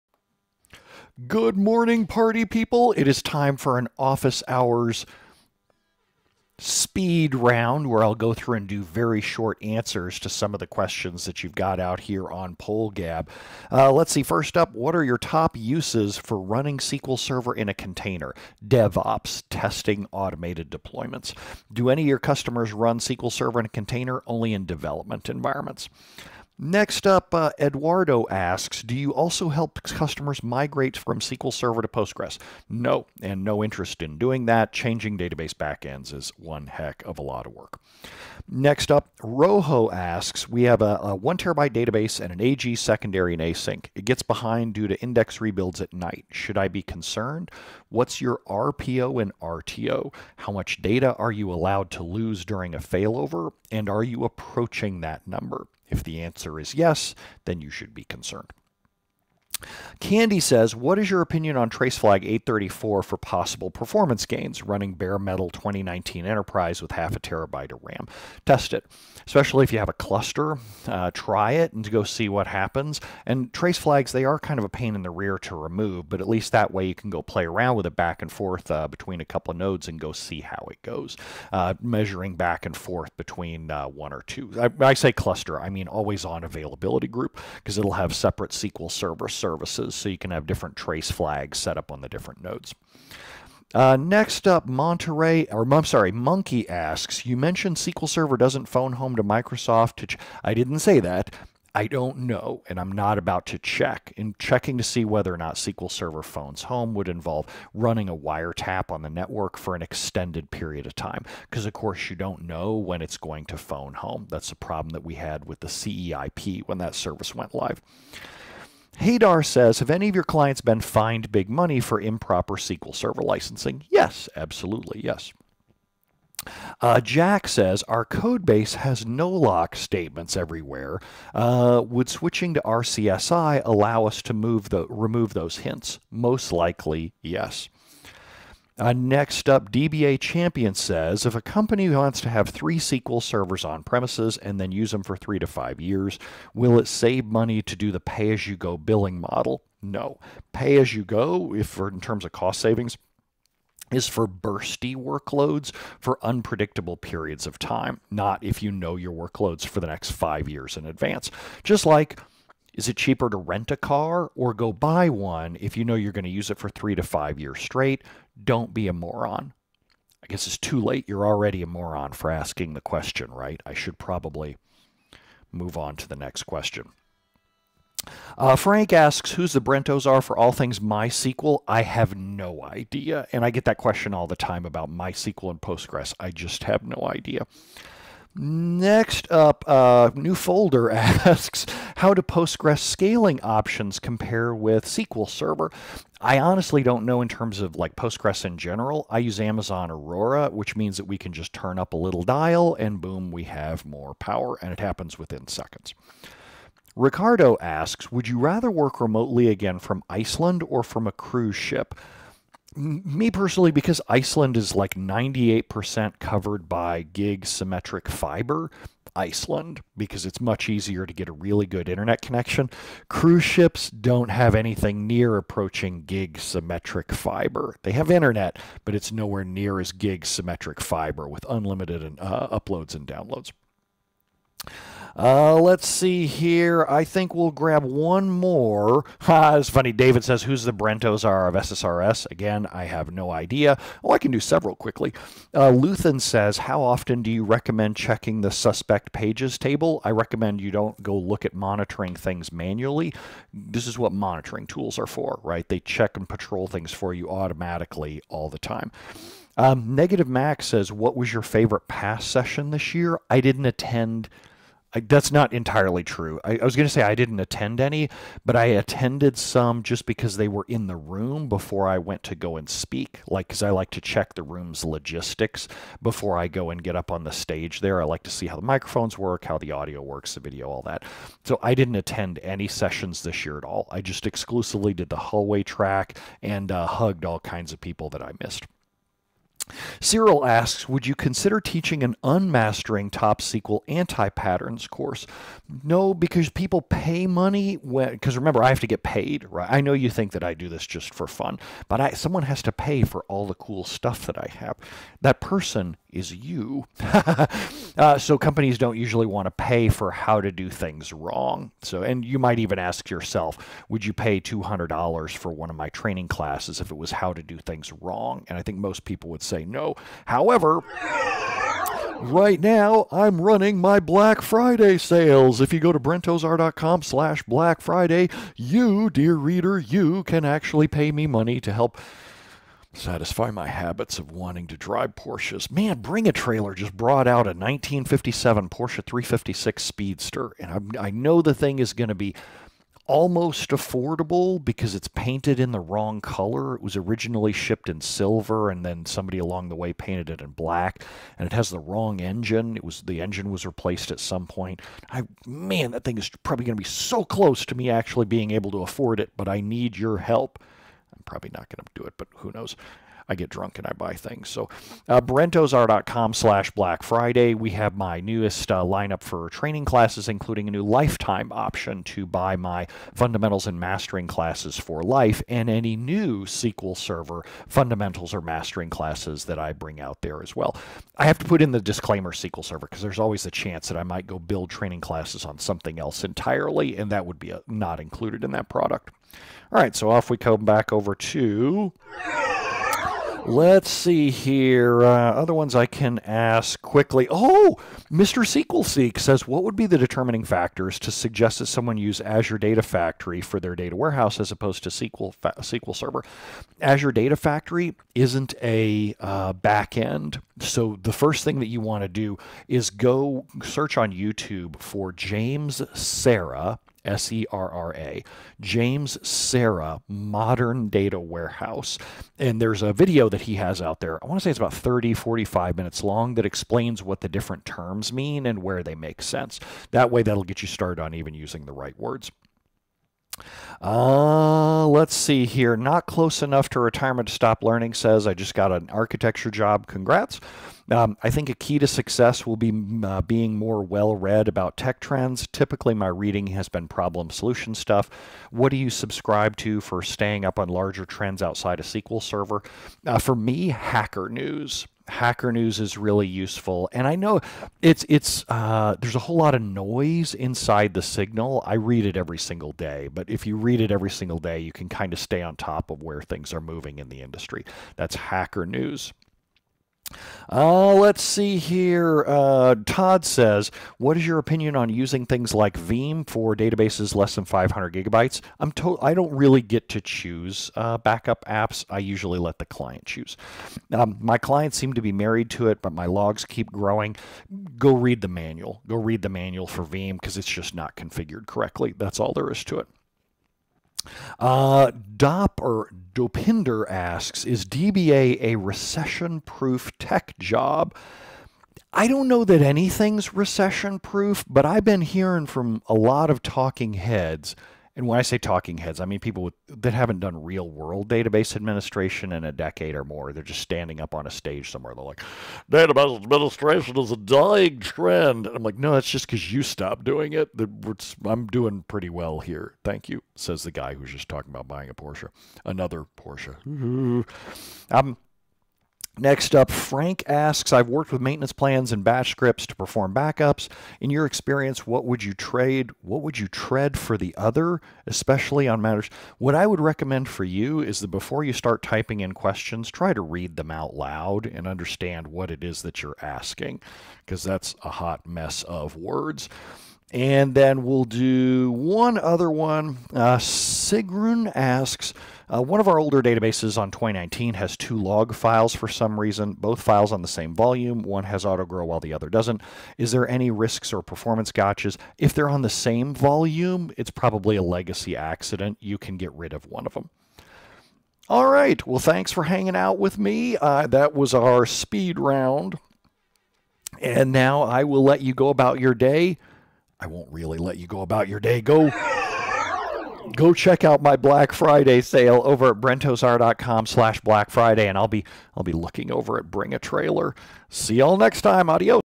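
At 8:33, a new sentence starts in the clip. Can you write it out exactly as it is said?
They're just standing up on a stage somewhere.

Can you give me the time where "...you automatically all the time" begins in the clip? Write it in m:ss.
4:17.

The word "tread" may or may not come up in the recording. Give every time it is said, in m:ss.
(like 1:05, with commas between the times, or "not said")
8:56.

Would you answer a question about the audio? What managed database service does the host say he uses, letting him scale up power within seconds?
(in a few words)
Amazon Aurora.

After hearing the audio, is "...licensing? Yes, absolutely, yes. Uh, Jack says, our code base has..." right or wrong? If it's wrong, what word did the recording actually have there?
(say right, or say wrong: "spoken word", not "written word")
right.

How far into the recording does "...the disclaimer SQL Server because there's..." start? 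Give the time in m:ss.
6:21.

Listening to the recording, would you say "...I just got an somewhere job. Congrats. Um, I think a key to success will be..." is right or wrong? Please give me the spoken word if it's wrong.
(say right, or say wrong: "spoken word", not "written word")
wrong: "architecture", not "somewhere".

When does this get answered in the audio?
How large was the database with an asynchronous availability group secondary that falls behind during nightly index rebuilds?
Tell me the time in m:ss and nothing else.
0:41.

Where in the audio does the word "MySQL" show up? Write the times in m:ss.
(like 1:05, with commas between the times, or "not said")
3:00, 3:04.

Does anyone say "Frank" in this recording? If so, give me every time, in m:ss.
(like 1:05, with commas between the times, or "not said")
2:58, 8:49.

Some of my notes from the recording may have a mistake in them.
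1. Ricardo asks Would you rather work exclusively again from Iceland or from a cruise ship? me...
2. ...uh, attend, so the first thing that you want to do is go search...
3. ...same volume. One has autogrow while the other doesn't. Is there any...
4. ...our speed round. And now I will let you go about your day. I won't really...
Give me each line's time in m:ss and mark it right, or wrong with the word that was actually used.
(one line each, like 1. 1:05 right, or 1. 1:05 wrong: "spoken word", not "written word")
1. 3:26 wrong: "remotely", not "exclusively"
2. 6:49 wrong: "backend", not "attend"
3. 9:20 right
4. 9:34 right.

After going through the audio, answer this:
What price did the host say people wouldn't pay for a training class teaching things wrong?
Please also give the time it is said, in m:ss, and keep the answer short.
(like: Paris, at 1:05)
$200, at 5:14.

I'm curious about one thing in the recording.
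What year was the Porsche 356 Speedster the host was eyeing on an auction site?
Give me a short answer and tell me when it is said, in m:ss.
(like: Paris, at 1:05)
1957, at 5:37.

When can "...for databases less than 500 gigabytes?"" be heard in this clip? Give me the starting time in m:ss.
7:56.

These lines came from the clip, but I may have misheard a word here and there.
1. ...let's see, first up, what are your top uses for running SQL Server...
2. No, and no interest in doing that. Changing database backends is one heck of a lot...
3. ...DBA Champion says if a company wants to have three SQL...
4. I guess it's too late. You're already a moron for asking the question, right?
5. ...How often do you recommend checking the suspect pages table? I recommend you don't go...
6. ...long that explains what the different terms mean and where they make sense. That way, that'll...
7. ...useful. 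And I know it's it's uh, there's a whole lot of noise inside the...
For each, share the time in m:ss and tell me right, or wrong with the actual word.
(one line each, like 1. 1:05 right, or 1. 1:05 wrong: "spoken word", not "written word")
1. 0:13 right
2. 0:32 right
3. 2:19 right
4. 2:50 right
5. 4:06 right
6. 7:06 right
7. 7:36 right.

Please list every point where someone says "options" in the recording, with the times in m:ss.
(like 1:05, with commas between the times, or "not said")
3:13, 6:11.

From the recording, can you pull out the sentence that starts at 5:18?
And I think most people would say no.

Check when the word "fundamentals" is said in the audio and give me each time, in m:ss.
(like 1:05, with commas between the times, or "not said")
6:13, 6:17.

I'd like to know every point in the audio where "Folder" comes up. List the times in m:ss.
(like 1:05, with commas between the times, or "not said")
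3:10.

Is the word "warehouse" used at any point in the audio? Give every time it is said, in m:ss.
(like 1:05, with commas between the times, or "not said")
6:43, 7:01.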